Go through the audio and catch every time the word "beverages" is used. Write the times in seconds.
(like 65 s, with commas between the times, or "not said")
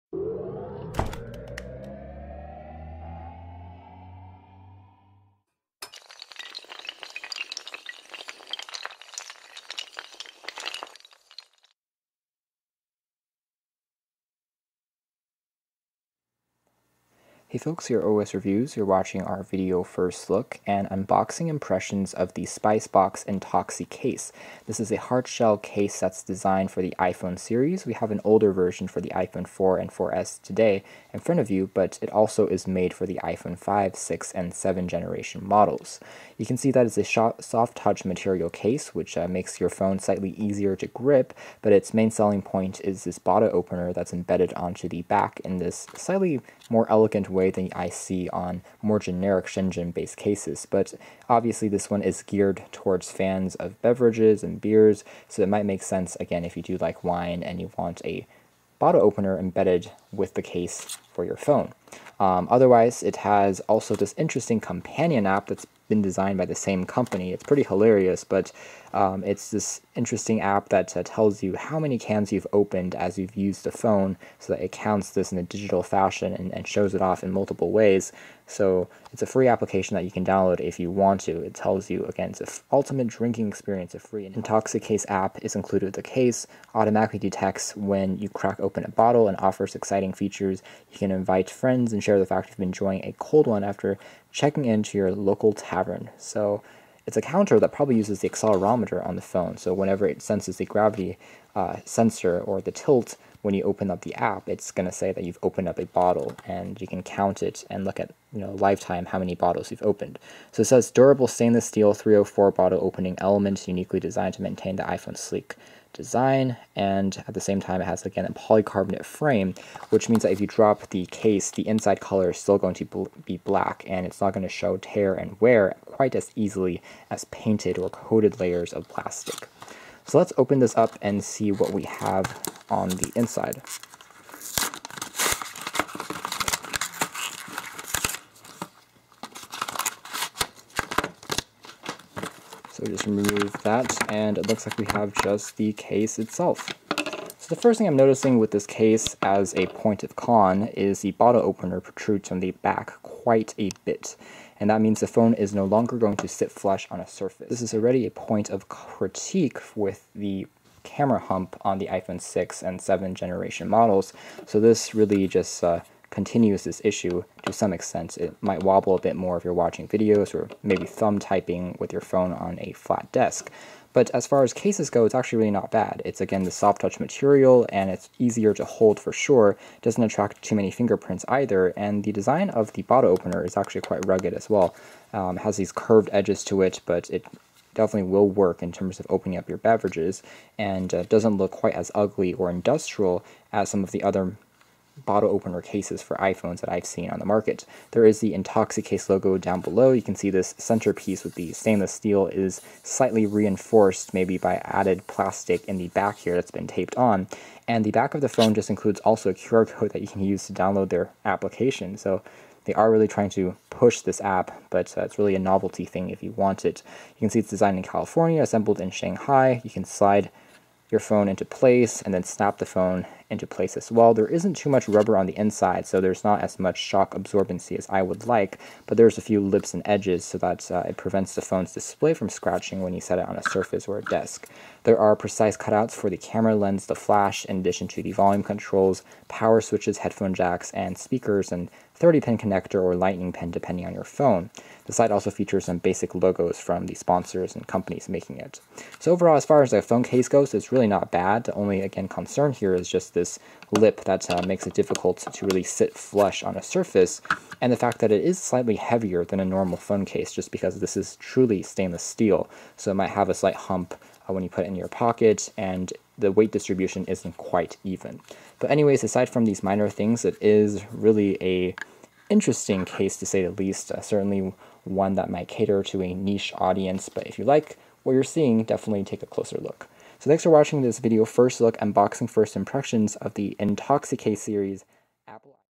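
53 s, 189 s.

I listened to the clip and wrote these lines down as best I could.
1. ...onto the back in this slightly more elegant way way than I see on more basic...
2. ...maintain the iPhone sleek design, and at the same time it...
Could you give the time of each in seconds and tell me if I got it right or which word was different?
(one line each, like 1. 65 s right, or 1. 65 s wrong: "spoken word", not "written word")
1. 44 s wrong: "generic", not "basic"
2. 114 s right.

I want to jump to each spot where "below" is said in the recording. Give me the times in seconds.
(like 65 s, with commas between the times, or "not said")
199 s.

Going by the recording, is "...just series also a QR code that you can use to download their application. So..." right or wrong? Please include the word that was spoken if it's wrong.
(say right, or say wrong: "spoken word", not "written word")
wrong: "includes", not "series".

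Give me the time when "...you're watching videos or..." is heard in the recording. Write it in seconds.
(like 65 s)
169 s.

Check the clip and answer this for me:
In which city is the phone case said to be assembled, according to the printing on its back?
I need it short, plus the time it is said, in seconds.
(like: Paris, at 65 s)
Shanghai, at 218 s.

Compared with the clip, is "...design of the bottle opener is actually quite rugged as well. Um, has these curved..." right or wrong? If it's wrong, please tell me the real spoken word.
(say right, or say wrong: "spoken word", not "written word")
right.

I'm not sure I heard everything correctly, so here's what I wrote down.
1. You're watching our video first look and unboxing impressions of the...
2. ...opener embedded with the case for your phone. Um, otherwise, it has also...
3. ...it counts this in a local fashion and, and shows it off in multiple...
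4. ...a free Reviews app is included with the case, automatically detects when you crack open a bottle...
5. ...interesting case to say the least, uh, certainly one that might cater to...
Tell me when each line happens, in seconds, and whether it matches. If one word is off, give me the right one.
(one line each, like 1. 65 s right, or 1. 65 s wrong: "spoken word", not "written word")
1. 18 s right
2. 59 s right
3. 74 s wrong: "digital", not "local"
4. 83 s wrong: "Intoxicase", not "Reviews"
5. 272 s right.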